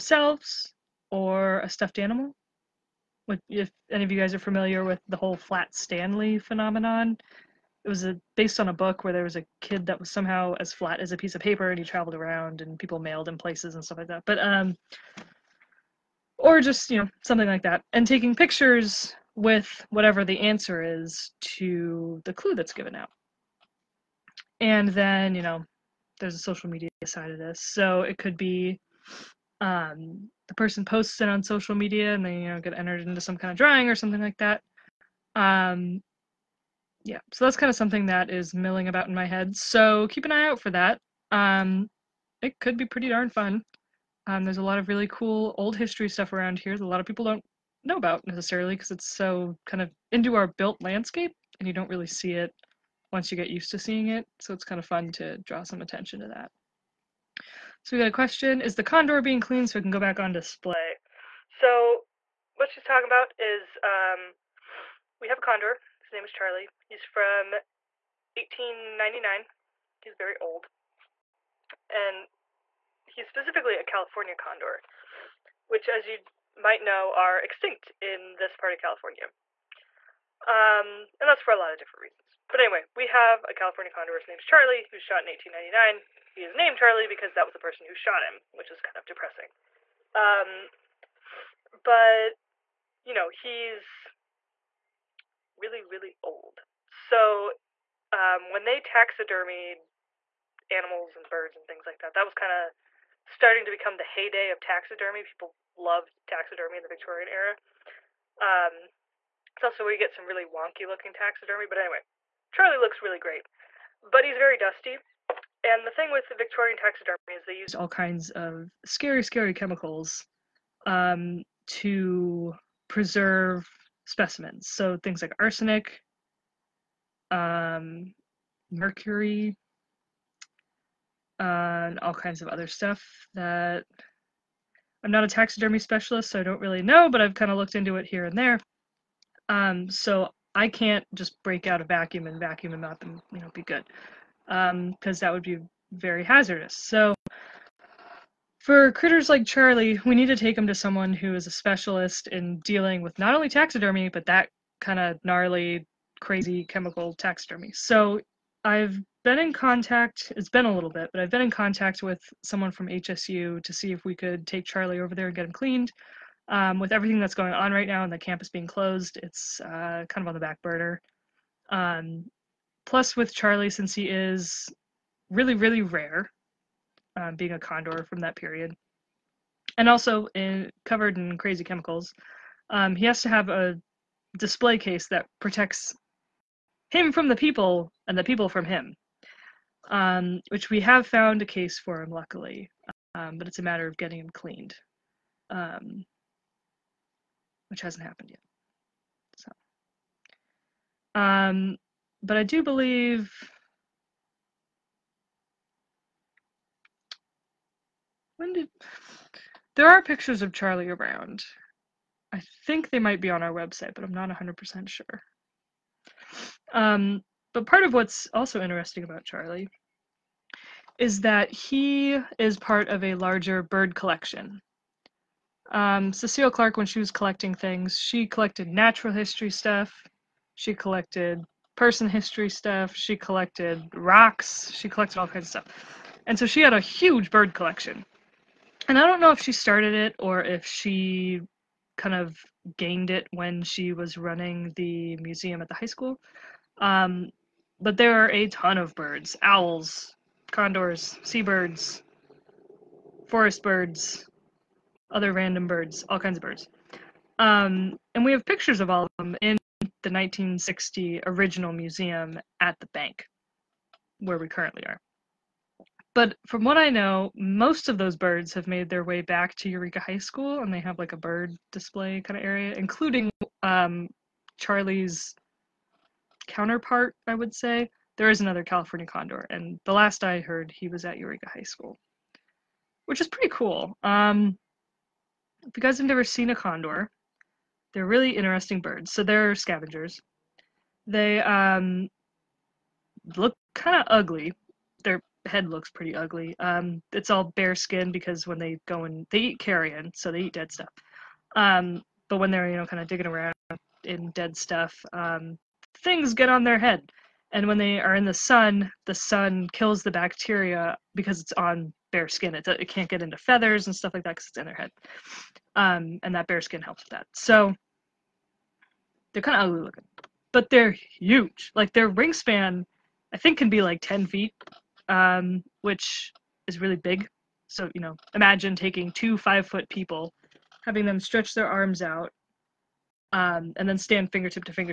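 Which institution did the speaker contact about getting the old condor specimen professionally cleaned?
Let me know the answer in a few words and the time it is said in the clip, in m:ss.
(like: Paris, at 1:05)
HSU, at 2:42.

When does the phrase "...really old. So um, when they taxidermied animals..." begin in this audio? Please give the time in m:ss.
1:35.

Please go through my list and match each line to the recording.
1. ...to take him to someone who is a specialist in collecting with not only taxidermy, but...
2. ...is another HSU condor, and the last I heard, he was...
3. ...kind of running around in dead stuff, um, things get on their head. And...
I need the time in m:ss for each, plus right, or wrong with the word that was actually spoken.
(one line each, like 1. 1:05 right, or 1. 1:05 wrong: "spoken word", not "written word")
1. 2:30 wrong: "dealing", not "collecting"
2. 4:38 wrong: "California", not "HSU"
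3. 5:02 wrong: "digging", not "running".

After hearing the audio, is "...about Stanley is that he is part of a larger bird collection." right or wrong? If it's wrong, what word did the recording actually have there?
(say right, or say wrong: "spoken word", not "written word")
wrong: "Charlie", not "Stanley".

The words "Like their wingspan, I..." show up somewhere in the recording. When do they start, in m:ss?
5:21.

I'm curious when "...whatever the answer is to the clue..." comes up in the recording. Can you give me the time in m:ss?
0:19.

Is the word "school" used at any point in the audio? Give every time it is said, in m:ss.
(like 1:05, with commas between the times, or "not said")
4:05, 4:30, 4:41.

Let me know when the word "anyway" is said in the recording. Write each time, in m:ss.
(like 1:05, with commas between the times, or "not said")
1:22, 1:51.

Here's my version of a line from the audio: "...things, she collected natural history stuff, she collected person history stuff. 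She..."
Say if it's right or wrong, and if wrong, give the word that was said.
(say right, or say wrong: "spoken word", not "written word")
right.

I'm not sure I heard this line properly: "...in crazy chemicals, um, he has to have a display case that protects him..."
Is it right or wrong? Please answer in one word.
right.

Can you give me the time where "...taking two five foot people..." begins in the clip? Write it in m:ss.
5:28.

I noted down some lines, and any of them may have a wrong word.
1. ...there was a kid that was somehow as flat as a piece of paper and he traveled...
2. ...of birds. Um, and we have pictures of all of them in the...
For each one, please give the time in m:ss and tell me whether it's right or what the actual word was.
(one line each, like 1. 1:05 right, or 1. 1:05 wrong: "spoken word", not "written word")
1. 0:09 right
2. 4:16 right.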